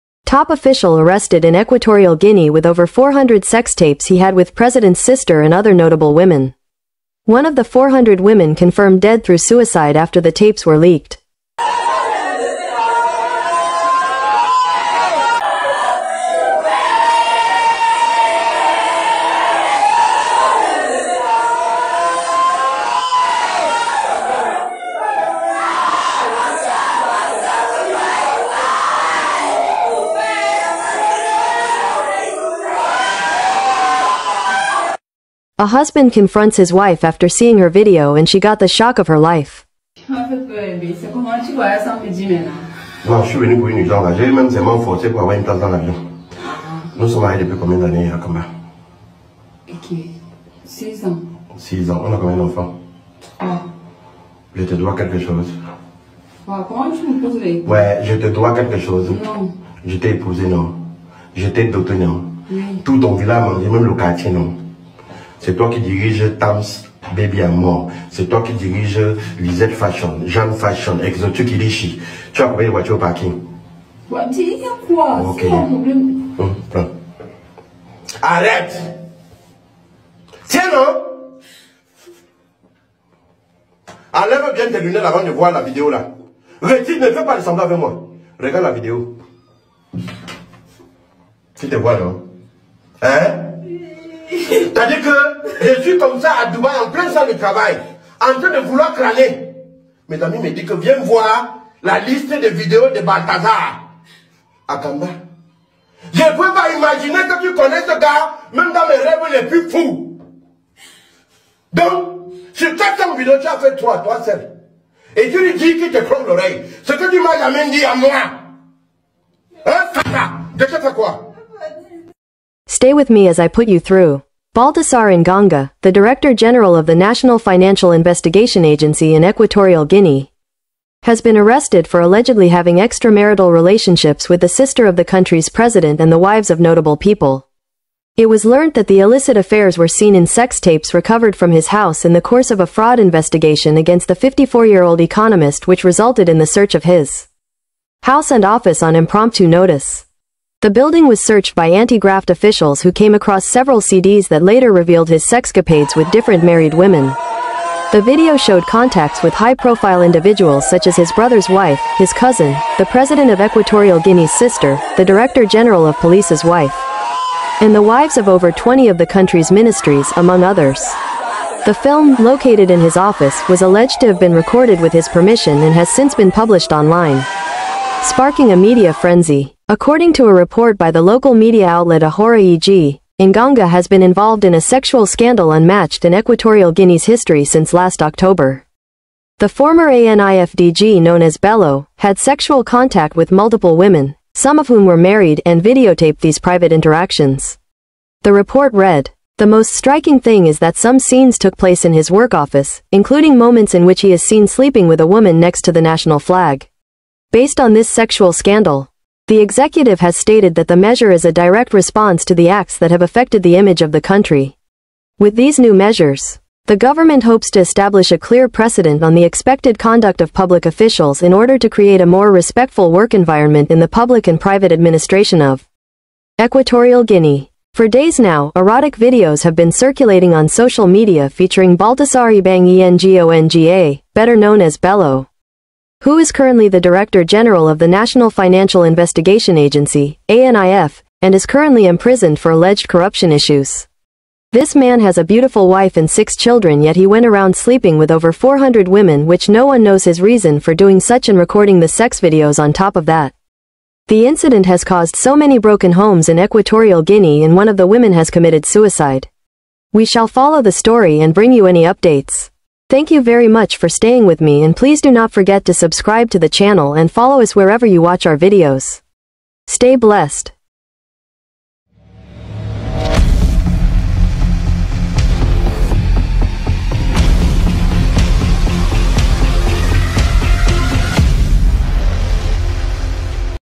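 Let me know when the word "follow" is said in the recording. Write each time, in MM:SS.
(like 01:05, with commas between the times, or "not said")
04:20, 04:27.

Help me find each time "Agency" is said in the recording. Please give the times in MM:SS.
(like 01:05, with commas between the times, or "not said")
02:08, 03:59.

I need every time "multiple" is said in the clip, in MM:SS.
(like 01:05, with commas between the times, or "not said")
03:13.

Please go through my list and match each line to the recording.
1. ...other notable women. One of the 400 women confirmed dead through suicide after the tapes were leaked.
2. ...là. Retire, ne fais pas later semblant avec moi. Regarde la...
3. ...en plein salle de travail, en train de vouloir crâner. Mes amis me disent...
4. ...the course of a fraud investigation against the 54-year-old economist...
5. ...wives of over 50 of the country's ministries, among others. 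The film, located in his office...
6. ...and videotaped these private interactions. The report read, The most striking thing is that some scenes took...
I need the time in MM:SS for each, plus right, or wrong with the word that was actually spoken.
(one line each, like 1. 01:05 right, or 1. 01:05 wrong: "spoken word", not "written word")
1. 00:05 right
2. 01:25 wrong: "ressembler", not "later"
3. 01:36 right
4. 02:22 right
5. 02:47 wrong: "20", not "50"
6. 03:15 right.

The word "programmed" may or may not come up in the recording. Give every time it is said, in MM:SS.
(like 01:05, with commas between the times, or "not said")
not said.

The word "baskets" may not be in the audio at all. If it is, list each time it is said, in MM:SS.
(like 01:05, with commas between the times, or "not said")
not said.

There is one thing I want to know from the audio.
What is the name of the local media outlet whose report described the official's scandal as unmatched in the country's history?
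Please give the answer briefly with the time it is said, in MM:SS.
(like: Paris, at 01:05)
Ahora EG, at 03:02.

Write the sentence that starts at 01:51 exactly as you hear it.
Donc, sur 400 vidéos, tu as fait toi, toi seul.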